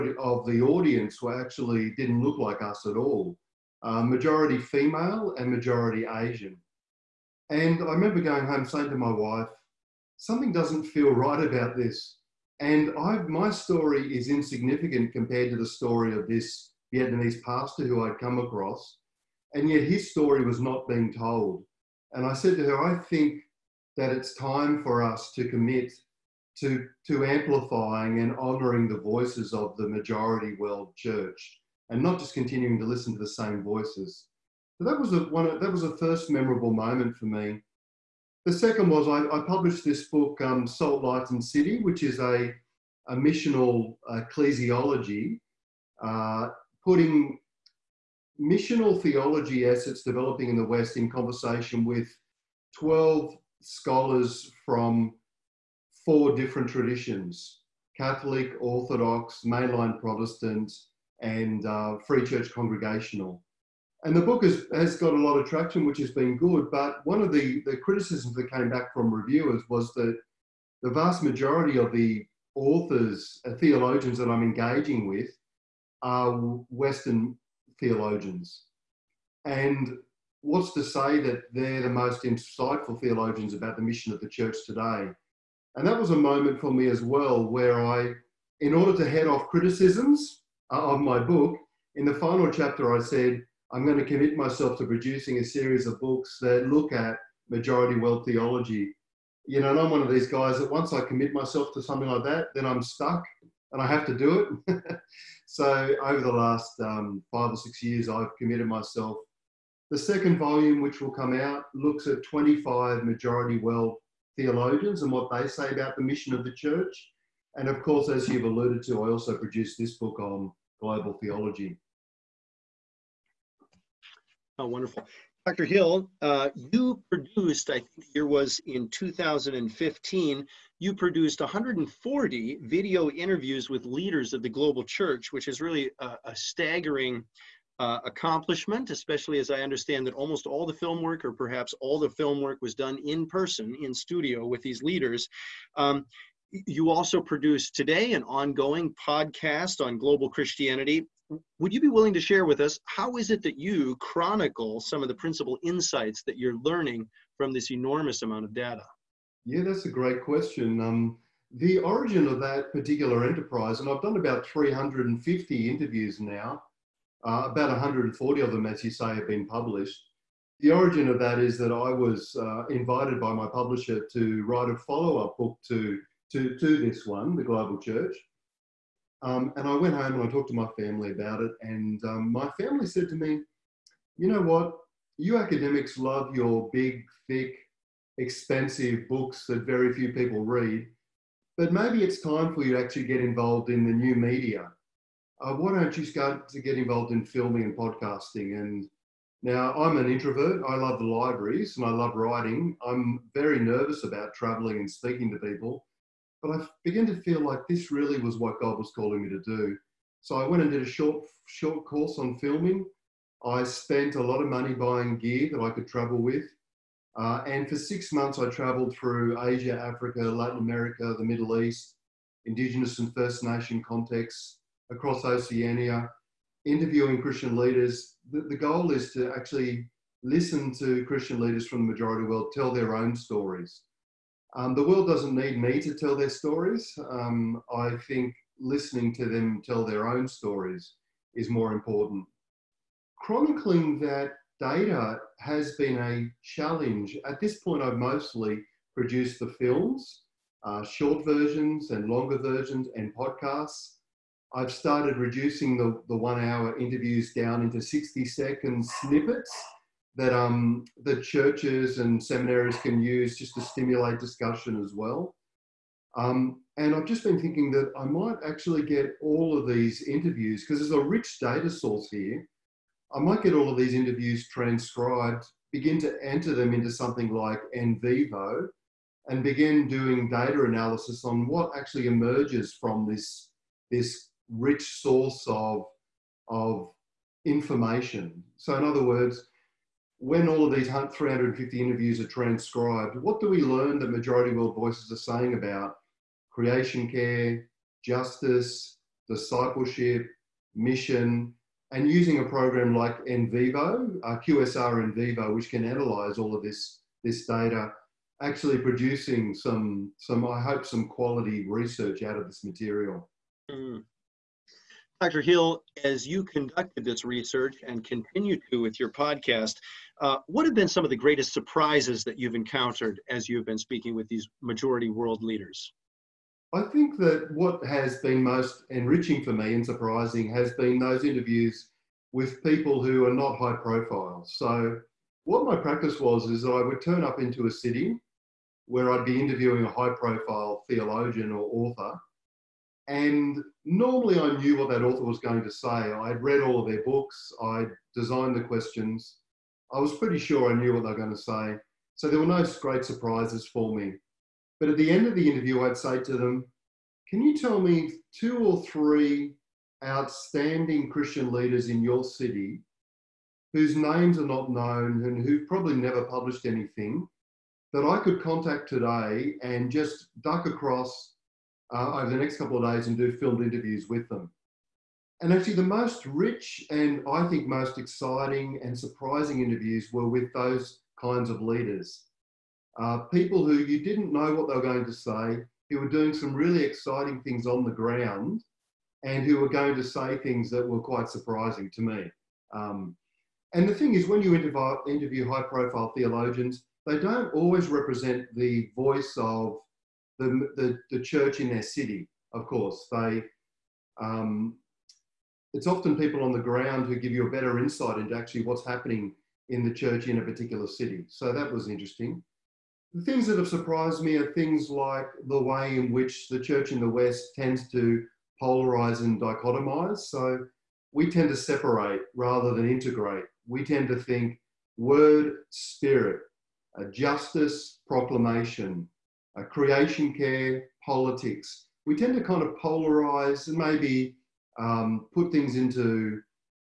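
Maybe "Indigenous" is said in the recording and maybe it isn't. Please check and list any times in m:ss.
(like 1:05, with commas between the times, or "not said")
3:42.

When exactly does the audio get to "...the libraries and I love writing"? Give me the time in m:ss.
3:20.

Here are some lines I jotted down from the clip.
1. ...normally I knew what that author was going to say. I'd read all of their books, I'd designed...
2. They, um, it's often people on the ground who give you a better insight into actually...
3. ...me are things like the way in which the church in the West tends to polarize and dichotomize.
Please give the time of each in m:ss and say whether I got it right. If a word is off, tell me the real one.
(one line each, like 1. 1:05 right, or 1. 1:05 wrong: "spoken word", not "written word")
1. 5:43 right
2. 6:43 right
3. 6:54 right.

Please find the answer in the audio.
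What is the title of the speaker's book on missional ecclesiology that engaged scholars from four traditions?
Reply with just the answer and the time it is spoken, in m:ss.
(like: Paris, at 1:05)
Salt, Light and City, at 0:40.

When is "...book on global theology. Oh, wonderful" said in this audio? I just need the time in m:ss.
1:59.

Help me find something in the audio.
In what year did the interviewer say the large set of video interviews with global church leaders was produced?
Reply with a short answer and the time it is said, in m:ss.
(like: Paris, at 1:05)
2015, at 2:08.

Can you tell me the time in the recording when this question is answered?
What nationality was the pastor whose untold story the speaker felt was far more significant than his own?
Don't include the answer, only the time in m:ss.
0:16.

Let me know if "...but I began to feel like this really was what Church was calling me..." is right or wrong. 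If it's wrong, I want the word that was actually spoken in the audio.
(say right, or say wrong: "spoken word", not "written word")
wrong: "God", not "Church".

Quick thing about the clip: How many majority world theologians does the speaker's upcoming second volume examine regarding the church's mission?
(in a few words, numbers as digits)
25.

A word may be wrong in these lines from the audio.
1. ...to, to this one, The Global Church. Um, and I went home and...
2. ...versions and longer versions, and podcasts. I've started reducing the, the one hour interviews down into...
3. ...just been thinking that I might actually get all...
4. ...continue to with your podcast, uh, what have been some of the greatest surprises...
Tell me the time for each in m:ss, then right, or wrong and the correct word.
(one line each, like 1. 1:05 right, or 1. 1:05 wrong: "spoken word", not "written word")
1. 2:56 right
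2. 4:11 right
3. 4:27 right
4. 5:18 right.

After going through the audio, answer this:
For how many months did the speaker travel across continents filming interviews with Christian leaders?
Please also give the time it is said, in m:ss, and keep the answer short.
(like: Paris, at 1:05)
6, at 3:37.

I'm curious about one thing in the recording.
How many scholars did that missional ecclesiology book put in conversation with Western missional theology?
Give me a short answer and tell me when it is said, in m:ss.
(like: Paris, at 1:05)
12, at 0:52.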